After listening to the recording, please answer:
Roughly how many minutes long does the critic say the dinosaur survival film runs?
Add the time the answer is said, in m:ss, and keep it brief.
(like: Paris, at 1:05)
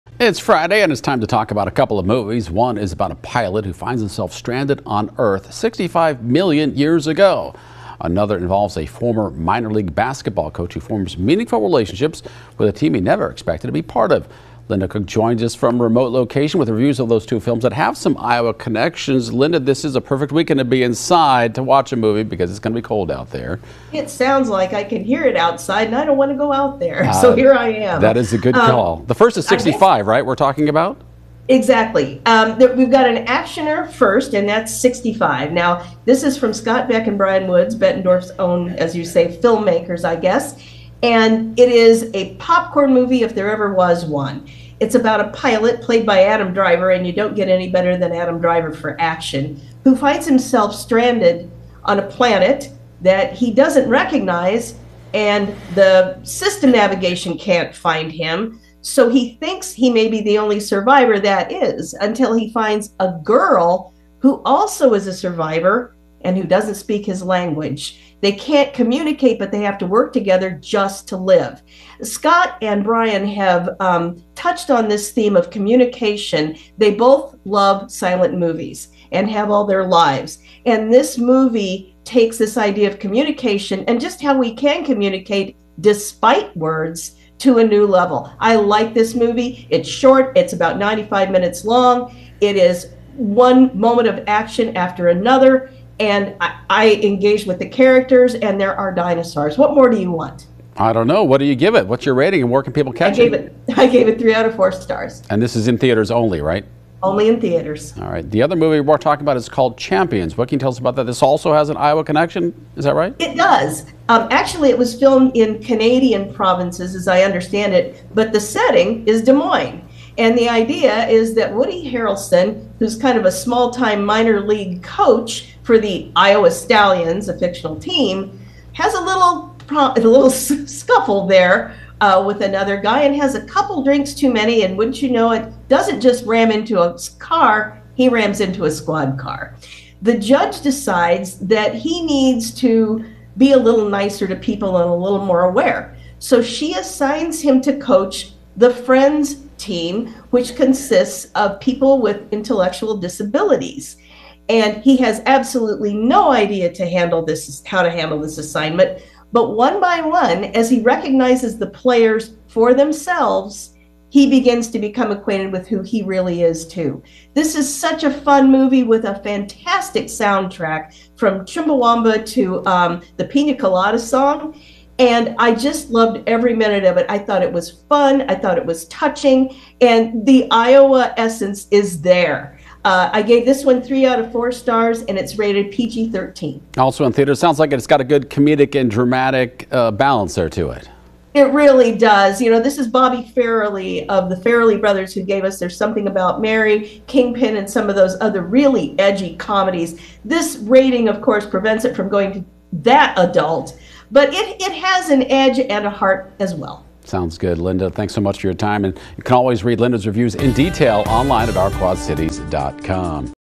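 95 minutes, at 1:30.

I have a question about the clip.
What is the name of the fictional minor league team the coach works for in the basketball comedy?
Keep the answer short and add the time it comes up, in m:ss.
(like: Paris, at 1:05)
Iowa Stallions, at 2:06.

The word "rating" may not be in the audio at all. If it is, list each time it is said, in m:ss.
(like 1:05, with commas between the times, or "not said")
1:42, 3:20.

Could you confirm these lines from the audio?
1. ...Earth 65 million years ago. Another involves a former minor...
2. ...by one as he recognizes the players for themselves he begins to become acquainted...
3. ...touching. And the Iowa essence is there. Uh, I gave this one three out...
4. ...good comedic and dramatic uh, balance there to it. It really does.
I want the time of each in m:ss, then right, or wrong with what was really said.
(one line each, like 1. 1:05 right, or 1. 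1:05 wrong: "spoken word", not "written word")
1. 0:05 right
2. 2:39 right
3. 2:58 right
4. 3:08 right.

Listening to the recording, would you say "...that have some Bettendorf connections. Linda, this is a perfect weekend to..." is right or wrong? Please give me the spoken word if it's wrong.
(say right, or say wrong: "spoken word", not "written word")
wrong: "Iowa", not "Bettendorf".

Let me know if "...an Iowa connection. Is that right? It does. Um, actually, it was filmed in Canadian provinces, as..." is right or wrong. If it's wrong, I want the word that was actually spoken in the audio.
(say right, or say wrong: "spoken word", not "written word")
right.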